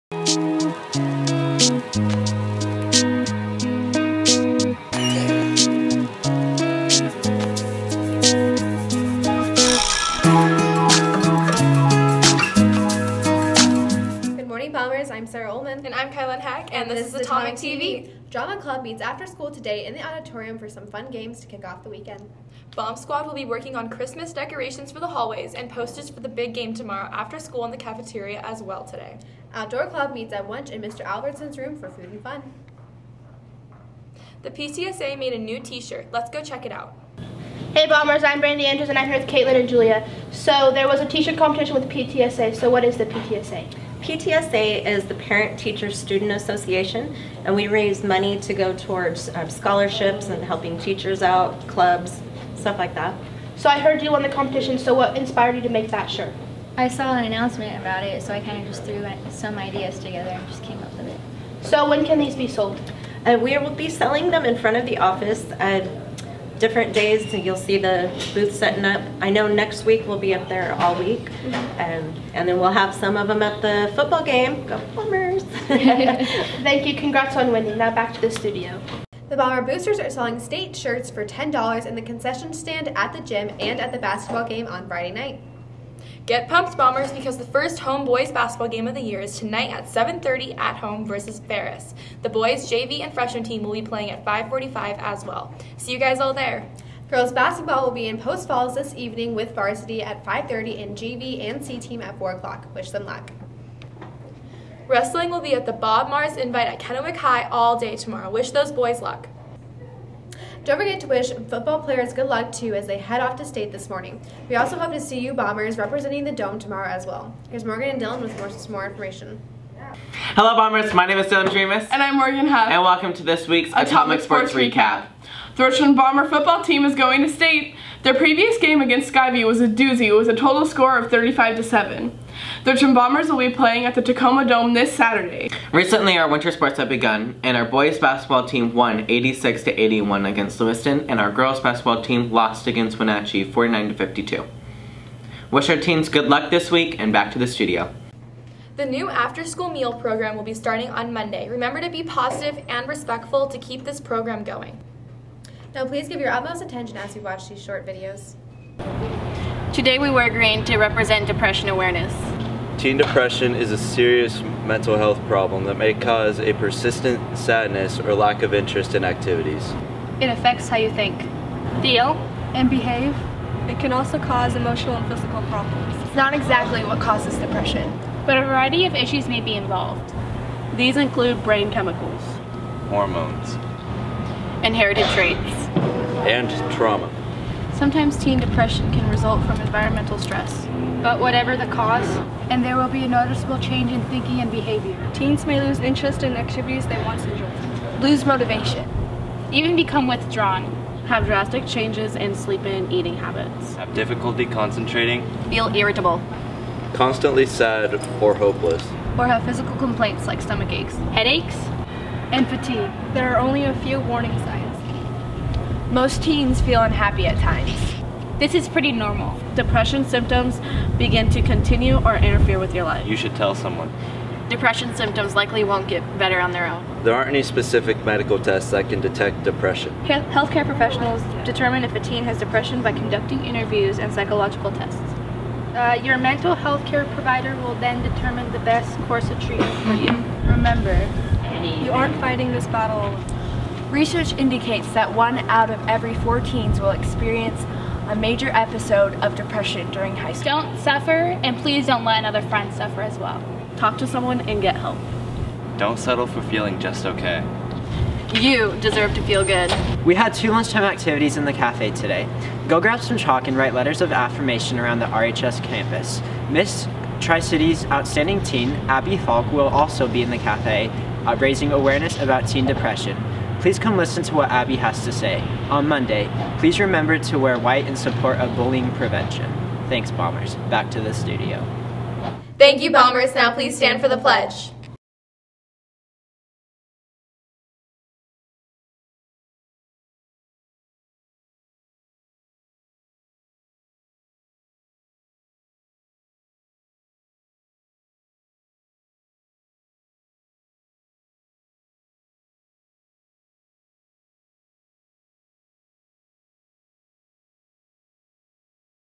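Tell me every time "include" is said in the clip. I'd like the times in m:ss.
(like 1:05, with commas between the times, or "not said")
3:00.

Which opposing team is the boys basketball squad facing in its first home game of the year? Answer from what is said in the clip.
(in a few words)
Ferris.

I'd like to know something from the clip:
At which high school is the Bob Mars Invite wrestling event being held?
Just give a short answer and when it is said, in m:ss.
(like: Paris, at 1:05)
Kennewick High, at 1:46.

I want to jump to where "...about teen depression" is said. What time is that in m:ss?
4:32.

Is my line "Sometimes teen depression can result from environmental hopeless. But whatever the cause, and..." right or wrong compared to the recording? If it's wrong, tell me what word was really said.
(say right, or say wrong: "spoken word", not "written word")
wrong: "stress", not "hopeless".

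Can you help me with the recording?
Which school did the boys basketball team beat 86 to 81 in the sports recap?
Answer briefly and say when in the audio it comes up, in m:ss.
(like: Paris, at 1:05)
Lewiston, at 2:20.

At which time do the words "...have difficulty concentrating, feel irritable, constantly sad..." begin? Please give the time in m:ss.
3:23.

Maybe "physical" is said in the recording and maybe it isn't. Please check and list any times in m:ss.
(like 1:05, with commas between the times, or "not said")
2:55, 3:29.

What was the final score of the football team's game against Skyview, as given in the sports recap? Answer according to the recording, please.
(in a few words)
35 to 7.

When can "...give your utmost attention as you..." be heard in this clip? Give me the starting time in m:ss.
2:36.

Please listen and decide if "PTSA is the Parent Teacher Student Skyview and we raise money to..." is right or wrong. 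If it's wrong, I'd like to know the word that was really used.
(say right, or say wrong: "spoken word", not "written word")
wrong: "Association", not "Skyview".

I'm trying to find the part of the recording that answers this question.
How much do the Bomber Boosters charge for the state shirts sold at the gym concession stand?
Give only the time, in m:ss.
1:21.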